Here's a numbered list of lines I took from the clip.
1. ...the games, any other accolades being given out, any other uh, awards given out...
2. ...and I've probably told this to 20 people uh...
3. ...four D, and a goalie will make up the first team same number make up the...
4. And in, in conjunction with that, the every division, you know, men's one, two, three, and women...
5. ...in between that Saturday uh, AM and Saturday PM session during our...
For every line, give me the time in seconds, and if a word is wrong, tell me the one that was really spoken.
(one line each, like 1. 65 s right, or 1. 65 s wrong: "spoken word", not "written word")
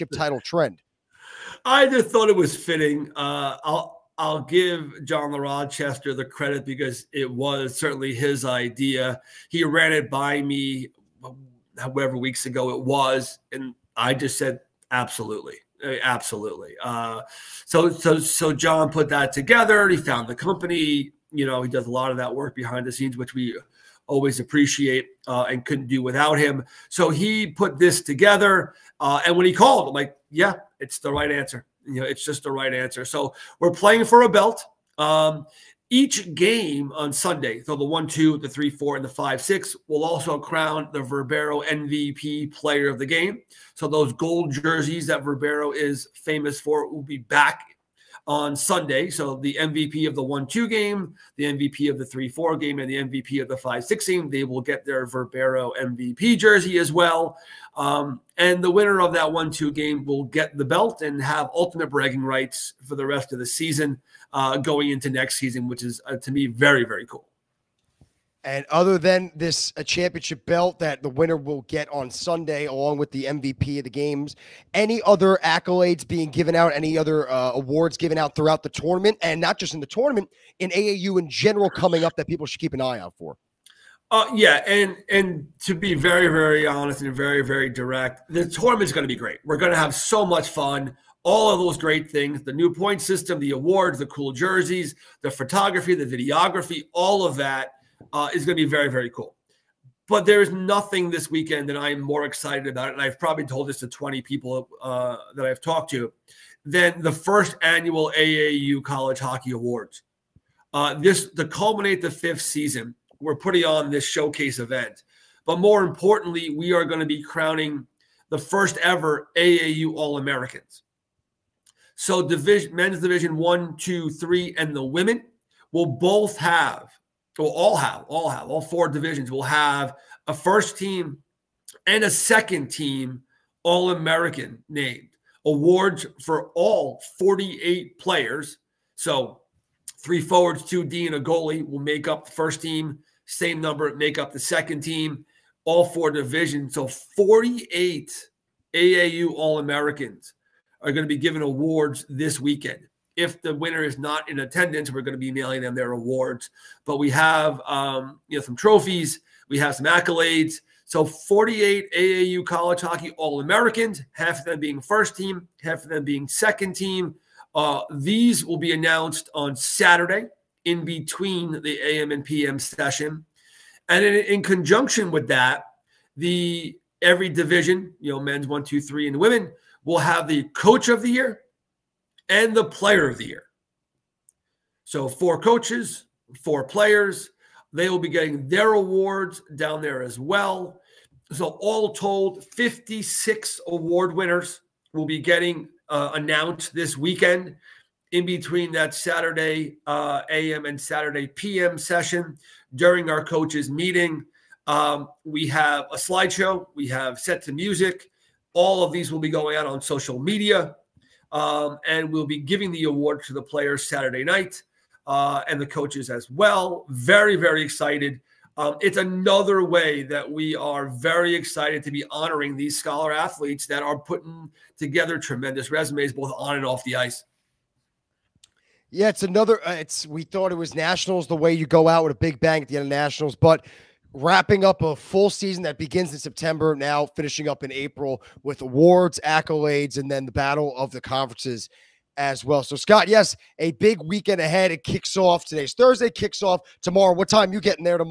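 1. 73 s right
2. 102 s right
3. 140 s wrong: "two", not "four"
4. 173 s right
5. 198 s right.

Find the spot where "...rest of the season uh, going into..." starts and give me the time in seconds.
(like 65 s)
63 s.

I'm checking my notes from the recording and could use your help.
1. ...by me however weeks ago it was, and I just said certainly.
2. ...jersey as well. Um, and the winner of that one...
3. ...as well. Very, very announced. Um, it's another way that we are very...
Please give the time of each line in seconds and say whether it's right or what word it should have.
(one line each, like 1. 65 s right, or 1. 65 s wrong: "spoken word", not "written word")
1. 10 s wrong: "absolutely", not "certainly"
2. 56 s right
3. 216 s wrong: "excited", not "announced".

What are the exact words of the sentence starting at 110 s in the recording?
Uh, this to culminate the fifth season we're putting on this showcase event.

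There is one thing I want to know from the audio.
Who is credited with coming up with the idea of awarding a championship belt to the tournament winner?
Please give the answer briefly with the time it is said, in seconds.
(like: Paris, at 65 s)
John La Rochester, at 5 s.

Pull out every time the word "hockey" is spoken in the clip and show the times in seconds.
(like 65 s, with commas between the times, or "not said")
109 s, 162 s.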